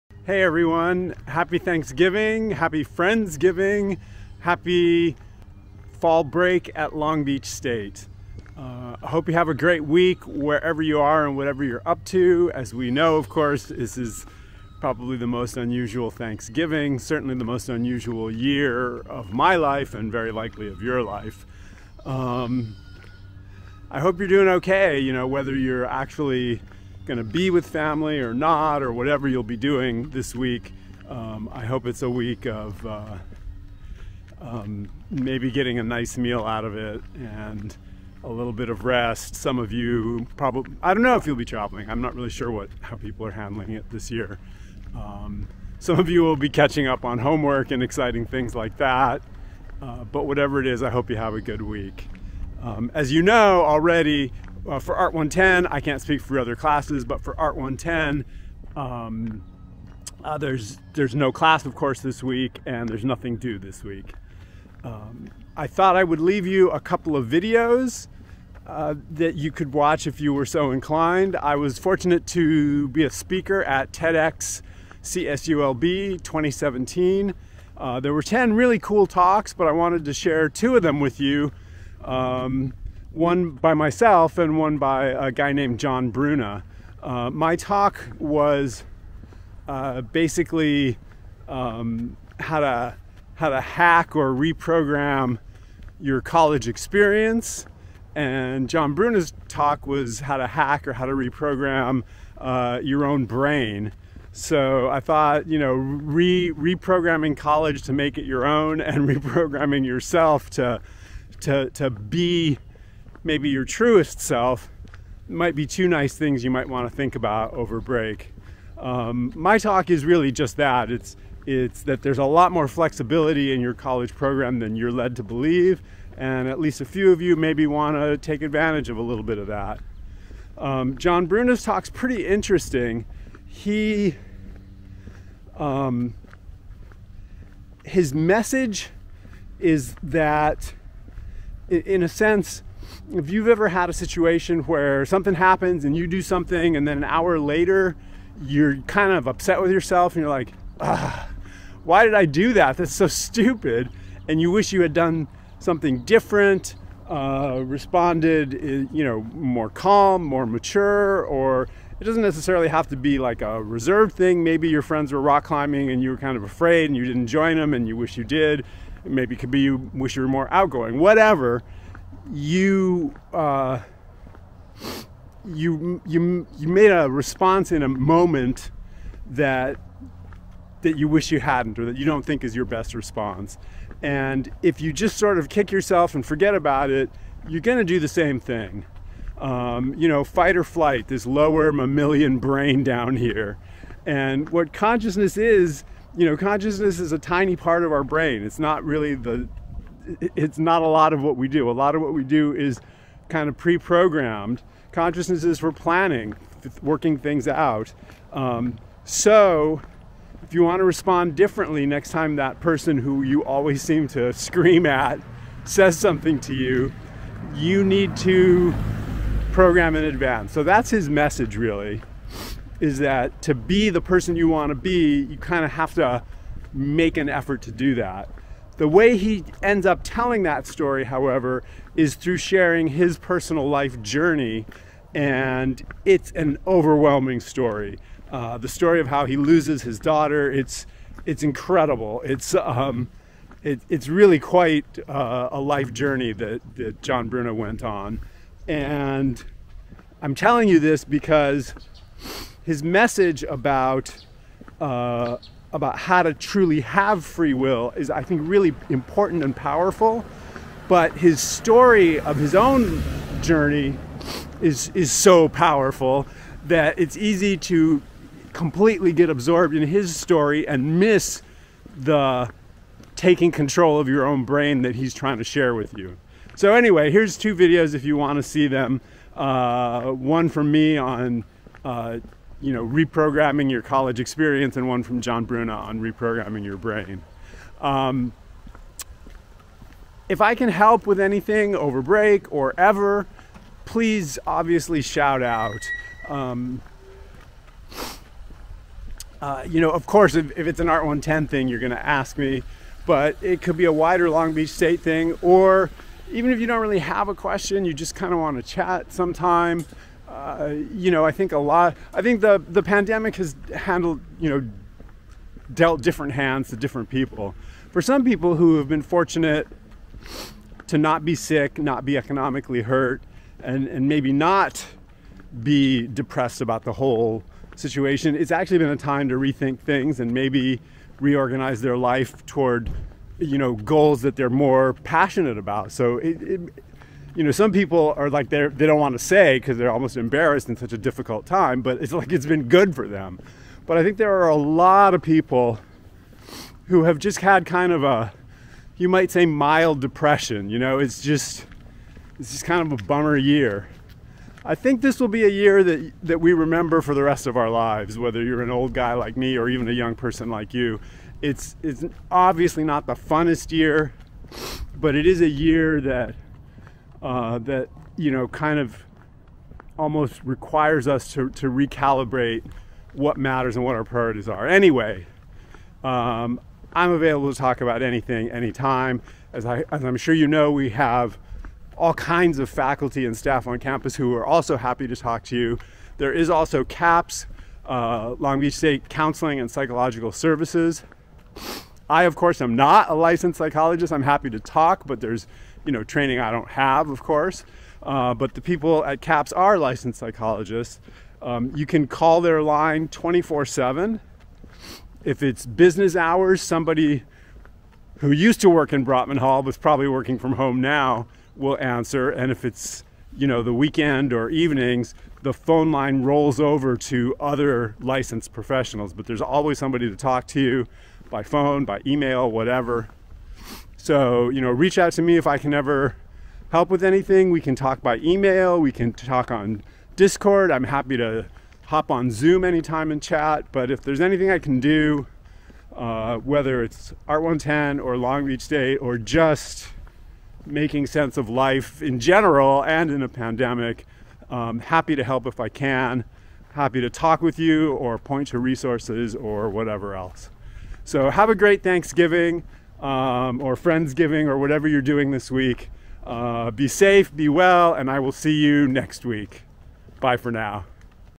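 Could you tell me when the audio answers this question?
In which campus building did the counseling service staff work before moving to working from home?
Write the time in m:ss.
6:49.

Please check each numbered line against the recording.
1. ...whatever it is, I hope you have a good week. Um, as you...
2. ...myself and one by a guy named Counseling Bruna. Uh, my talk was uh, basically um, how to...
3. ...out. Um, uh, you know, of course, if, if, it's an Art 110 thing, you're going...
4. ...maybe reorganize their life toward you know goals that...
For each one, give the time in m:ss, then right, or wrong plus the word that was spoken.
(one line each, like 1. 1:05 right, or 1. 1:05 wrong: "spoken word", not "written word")
1. 0:50 right
2. 1:23 wrong: "John", not "Counseling"
3. 4:55 right
4. 5:30 right.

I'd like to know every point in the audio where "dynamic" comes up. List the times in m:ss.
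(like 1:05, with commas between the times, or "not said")
not said.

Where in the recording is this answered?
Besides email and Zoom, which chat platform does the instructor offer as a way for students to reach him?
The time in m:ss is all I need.
7:10.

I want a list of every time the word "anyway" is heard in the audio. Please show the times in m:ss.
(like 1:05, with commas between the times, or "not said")
4:36, 6:14.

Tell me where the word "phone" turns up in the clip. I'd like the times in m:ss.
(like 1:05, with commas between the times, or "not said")
6:55, 7:01.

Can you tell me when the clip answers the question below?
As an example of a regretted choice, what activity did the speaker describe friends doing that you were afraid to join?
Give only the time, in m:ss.
2:45.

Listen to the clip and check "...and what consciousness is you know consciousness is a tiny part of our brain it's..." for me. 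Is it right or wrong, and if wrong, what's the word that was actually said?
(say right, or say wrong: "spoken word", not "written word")
right.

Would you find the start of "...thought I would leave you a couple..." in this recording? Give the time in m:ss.
1:05.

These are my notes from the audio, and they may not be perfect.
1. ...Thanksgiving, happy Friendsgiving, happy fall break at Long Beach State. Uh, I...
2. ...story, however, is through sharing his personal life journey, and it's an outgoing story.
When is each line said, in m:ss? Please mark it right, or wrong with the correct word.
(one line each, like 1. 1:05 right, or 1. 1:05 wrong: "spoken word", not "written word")
1. 0:01 right
2. 3:50 wrong: "overwhelming", not "outgoing".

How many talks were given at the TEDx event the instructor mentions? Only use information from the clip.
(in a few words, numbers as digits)
10.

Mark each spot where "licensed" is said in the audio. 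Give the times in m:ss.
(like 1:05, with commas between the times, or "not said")
6:33, 6:39, 6:57.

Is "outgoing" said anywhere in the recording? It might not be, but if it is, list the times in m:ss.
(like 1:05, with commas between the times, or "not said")
2:50.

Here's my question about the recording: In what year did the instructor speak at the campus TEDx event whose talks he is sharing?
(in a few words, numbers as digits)
2017.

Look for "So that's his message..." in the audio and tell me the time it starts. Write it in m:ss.
3:40.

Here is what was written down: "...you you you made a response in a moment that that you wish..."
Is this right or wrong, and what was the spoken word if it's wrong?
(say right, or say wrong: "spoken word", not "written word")
right.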